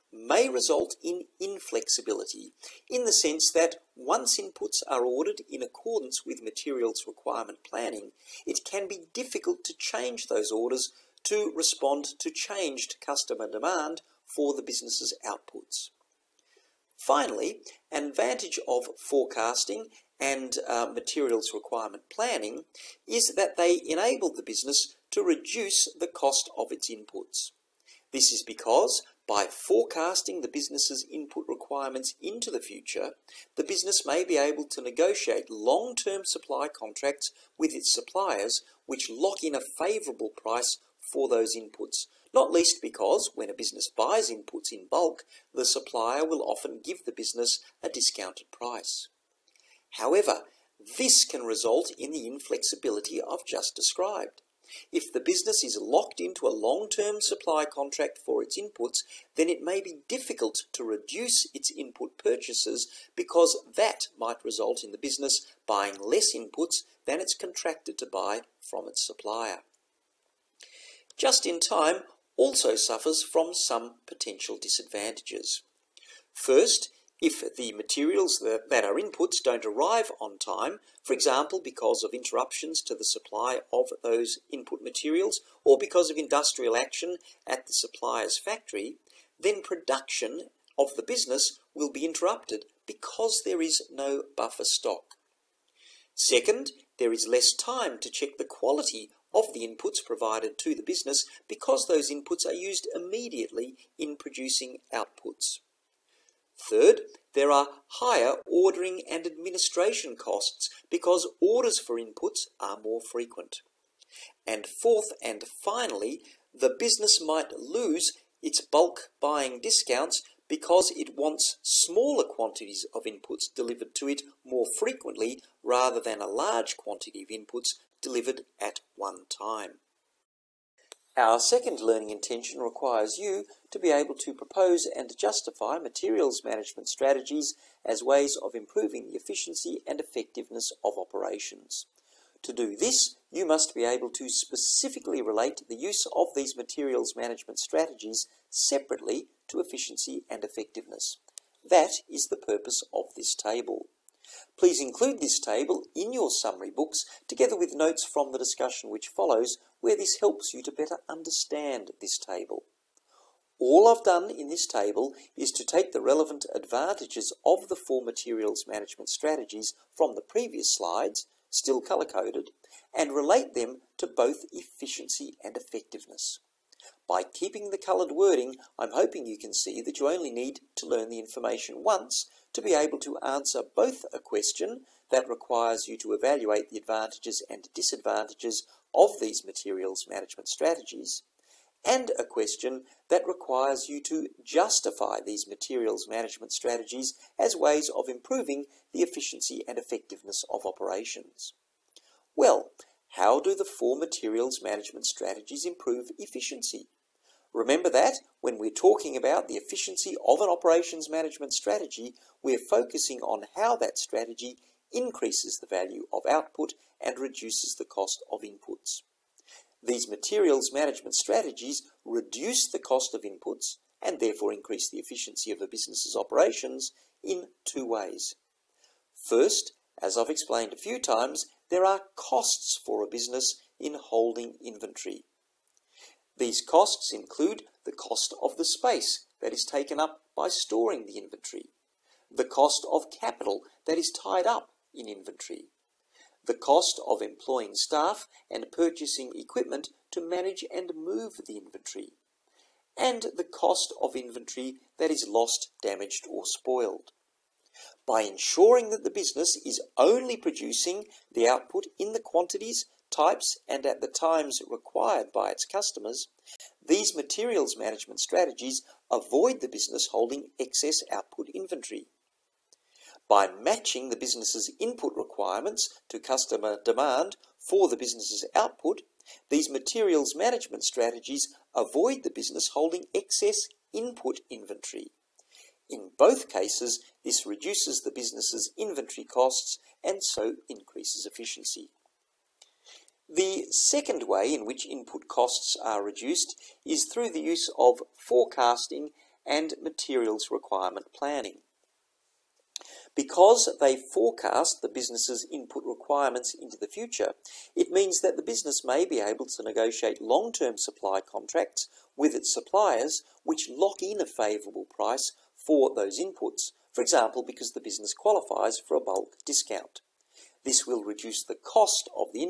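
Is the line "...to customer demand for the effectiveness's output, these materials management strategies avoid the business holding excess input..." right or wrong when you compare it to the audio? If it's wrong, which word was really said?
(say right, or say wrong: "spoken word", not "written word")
wrong: "business", not "effectiveness".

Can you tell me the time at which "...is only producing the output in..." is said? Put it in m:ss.
4:19.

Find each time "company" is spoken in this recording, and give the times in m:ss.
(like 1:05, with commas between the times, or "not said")
not said.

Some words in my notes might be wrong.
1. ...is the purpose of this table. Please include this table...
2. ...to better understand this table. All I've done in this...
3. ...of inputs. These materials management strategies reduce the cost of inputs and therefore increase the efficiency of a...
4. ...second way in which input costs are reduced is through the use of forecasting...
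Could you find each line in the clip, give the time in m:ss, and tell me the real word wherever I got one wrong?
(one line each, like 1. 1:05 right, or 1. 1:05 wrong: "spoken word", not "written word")
1. 2:32 right
2. 2:40 right
3. 3:38 right
4. 4:53 right.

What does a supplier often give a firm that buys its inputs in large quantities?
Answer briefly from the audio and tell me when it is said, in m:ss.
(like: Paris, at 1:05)
a discounted price, at 0:47.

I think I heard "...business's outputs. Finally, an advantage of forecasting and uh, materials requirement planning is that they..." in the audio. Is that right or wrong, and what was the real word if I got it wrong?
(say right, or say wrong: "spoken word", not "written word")
right.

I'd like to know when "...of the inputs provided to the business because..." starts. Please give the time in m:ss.
1:39.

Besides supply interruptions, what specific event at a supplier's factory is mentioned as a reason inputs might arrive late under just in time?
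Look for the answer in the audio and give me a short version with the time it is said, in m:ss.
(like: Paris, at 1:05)
industrial action, at 1:26.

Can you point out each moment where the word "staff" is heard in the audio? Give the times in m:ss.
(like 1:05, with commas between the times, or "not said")
4:07.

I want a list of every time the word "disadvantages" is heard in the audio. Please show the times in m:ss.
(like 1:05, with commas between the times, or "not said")
1:14, 3:07.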